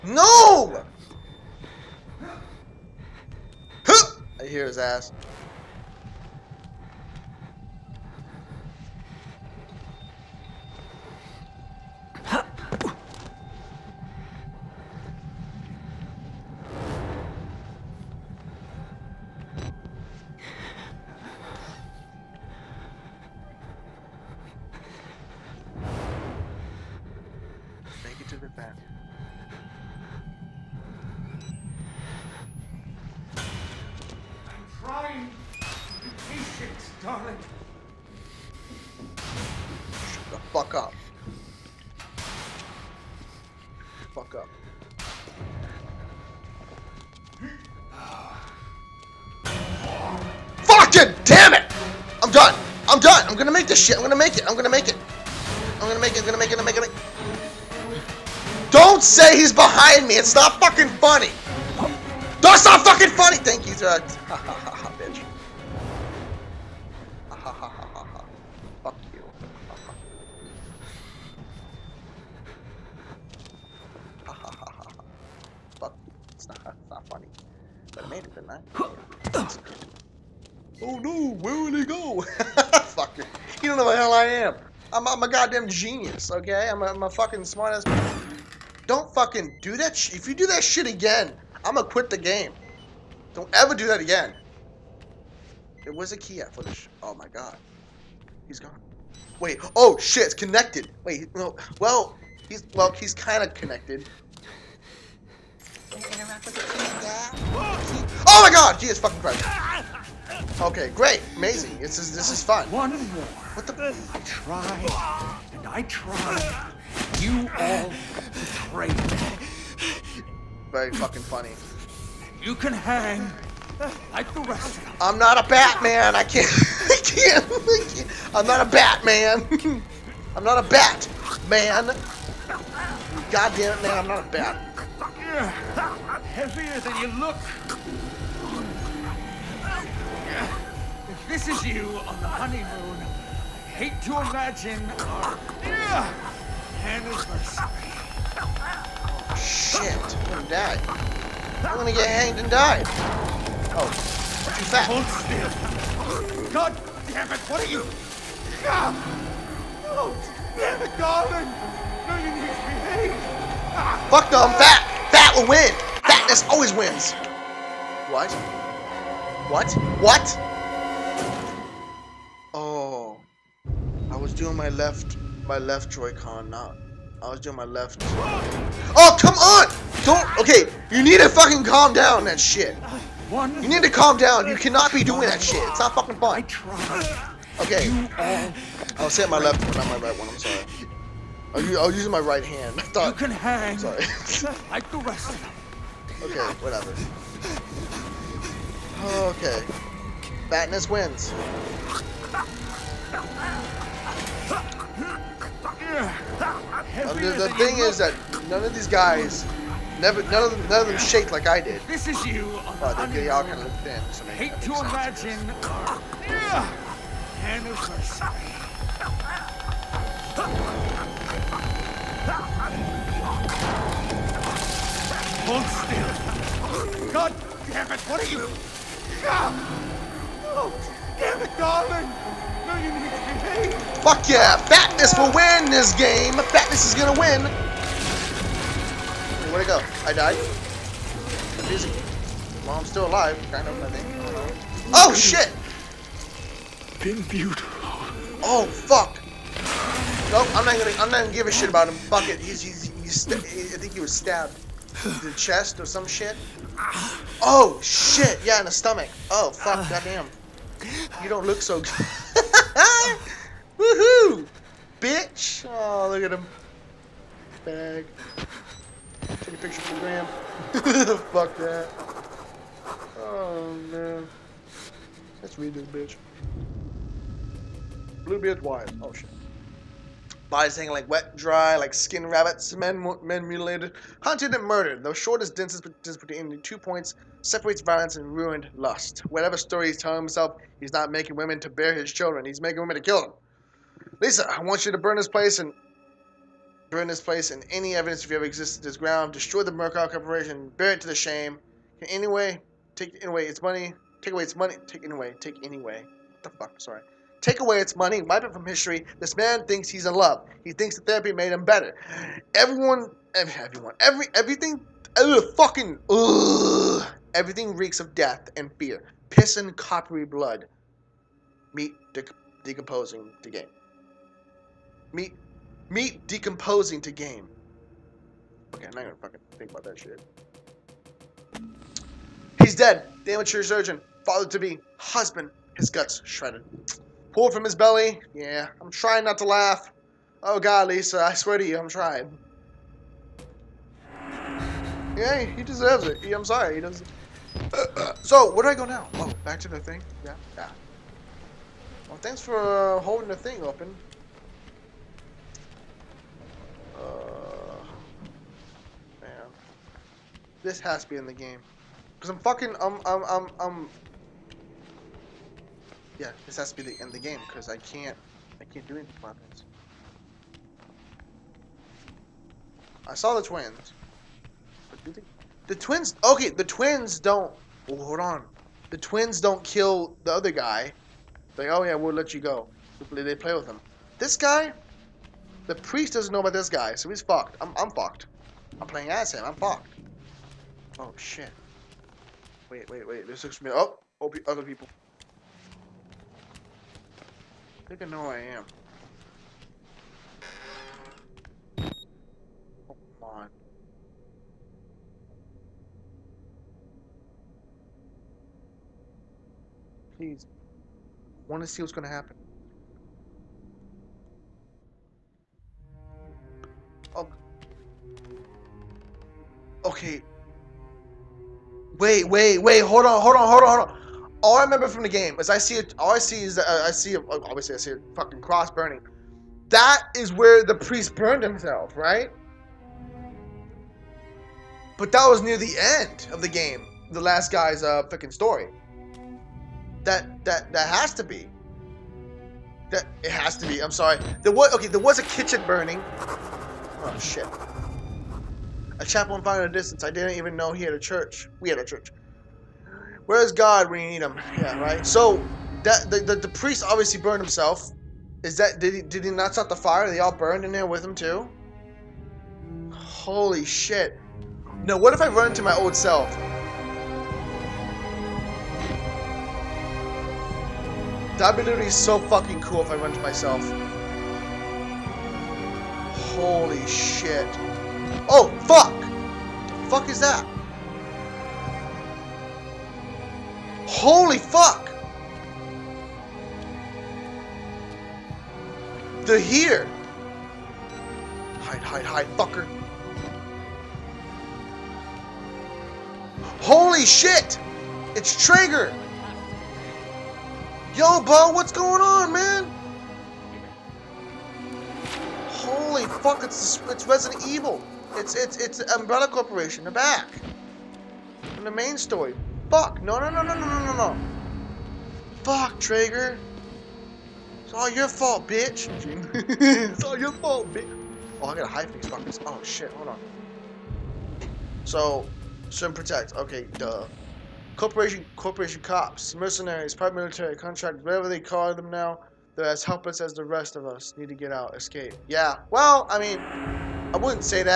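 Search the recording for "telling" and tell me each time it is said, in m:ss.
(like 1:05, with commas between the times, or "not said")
4:49.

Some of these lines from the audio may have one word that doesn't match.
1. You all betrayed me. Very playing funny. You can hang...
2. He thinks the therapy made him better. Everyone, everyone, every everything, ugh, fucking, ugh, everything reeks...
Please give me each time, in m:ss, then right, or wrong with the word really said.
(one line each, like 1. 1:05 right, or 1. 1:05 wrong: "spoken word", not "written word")
1. 1:57 wrong: "fucking", not "playing"
2. 5:10 right.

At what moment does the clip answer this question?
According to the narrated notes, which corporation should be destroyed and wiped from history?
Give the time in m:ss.
4:59.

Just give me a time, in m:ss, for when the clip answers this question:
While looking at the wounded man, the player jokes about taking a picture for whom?
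4:29.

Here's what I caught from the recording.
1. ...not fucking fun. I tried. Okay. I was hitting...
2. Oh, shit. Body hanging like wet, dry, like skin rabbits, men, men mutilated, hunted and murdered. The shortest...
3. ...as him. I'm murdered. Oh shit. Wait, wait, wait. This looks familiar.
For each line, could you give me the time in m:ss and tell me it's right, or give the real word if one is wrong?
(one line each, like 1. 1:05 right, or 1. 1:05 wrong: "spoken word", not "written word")
1. 3:05 right
2. 4:39 right
3. 6:29 wrong: "fucked", not "murdered".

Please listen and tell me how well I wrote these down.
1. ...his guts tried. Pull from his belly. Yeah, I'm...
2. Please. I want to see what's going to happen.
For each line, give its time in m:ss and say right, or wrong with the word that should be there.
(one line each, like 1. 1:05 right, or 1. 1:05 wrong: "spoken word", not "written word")
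1. 5:35 wrong: "shredded", not "tried"
2. 6:50 right.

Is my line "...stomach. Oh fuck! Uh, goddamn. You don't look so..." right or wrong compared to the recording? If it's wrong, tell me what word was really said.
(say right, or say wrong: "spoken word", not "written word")
right.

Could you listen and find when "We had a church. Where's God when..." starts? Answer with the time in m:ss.
7:31.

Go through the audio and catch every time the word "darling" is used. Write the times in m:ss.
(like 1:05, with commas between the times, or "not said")
2:40, 3:51.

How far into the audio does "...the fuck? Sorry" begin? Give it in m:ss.
5:06.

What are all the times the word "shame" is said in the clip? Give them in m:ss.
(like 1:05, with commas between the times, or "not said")
5:01.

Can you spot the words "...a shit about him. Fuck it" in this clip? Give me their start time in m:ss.
4:11.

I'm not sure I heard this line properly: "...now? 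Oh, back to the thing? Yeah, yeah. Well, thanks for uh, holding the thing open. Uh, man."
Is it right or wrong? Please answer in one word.
right.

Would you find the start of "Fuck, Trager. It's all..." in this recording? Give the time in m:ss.
8:35.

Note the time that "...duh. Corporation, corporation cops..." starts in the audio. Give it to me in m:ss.
8:46.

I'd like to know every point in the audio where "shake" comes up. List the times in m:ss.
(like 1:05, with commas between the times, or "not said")
3:30.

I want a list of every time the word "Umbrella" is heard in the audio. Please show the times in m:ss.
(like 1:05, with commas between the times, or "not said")
8:28.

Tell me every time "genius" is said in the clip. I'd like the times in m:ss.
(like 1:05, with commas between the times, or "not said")
1:25.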